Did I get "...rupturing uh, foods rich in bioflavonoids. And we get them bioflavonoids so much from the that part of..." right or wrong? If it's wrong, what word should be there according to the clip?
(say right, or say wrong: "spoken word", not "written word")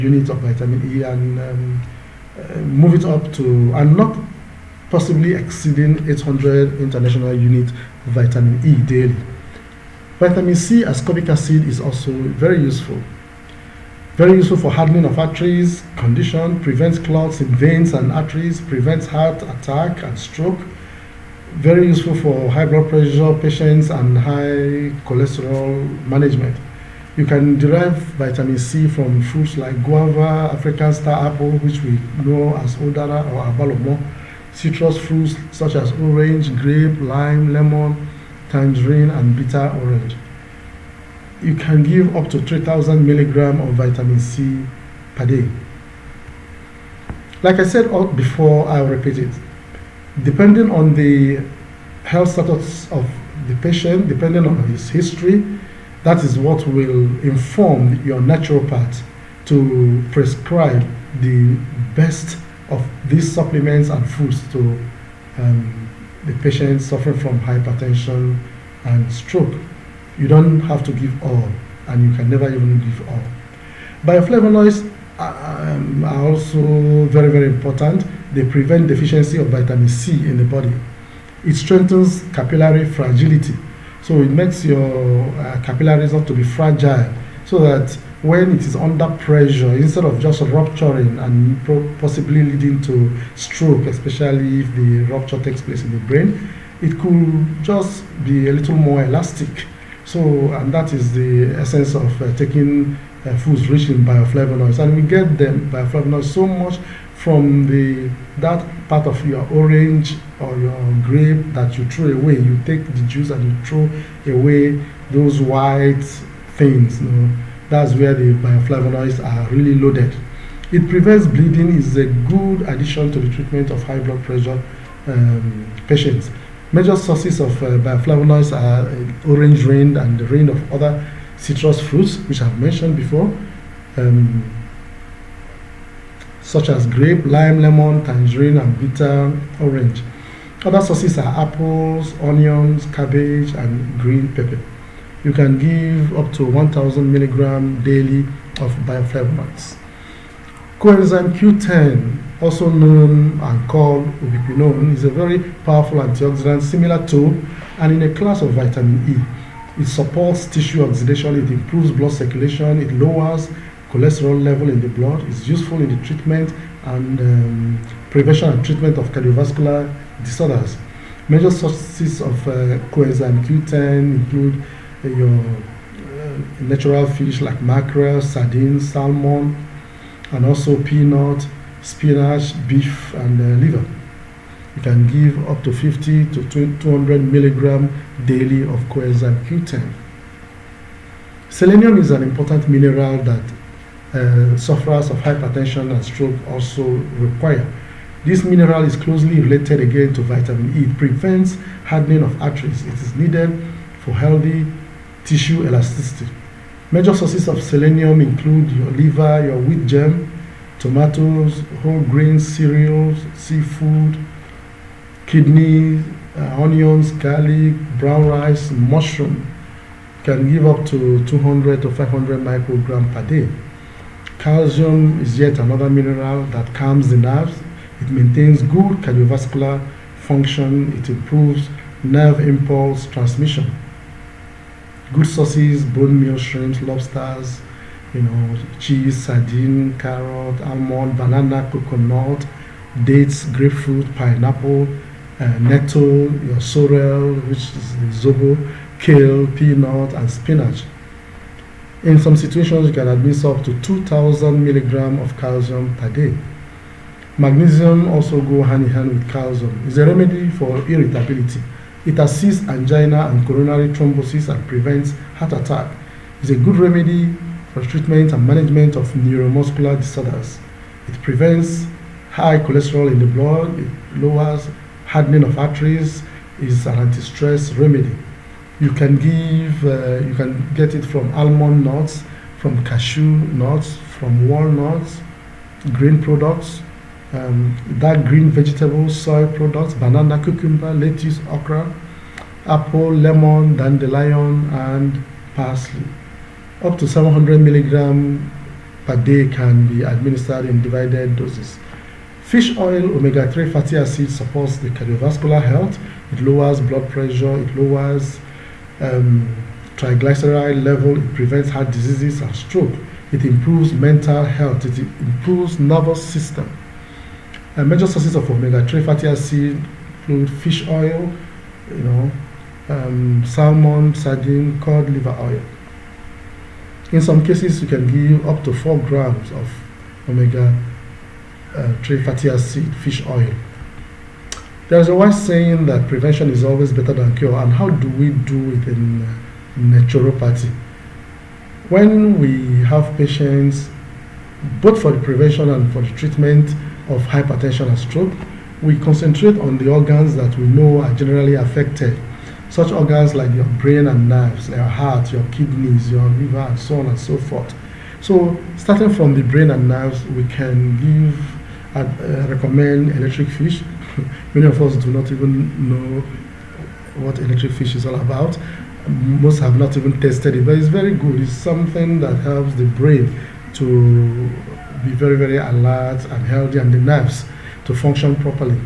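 wrong: "taking", not "rupturing".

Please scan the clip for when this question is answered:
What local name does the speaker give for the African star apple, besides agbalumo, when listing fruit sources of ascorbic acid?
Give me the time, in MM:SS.
00:32.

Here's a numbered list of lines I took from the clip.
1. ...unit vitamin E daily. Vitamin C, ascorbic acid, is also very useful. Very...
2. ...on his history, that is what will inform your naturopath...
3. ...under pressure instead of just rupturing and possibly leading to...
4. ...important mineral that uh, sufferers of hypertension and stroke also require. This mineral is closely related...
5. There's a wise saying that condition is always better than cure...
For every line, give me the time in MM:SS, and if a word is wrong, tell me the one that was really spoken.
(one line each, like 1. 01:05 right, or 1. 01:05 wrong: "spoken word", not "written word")
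1. 00:07 right
2. 00:54 right
3. 01:28 right
4. 03:12 right
5. 05:34 wrong: "prevention", not "condition".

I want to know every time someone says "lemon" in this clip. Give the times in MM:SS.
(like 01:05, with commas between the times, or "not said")
00:37, 02:17, 04:53.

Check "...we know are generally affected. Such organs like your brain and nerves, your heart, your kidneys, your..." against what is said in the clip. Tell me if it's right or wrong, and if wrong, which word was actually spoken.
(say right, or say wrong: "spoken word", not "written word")
right.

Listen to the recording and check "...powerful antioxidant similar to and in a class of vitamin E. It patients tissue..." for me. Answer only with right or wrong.
wrong.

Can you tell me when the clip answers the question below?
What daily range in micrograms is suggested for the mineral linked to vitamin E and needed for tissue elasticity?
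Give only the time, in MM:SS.
03:41.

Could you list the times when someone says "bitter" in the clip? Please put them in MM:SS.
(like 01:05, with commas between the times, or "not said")
00:39, 02:18.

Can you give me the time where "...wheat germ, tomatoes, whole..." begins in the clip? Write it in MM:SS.
03:29.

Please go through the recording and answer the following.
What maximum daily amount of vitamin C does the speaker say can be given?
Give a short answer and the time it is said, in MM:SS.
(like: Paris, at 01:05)
3000 milligrams, at 00:42.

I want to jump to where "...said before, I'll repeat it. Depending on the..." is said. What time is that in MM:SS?
00:47.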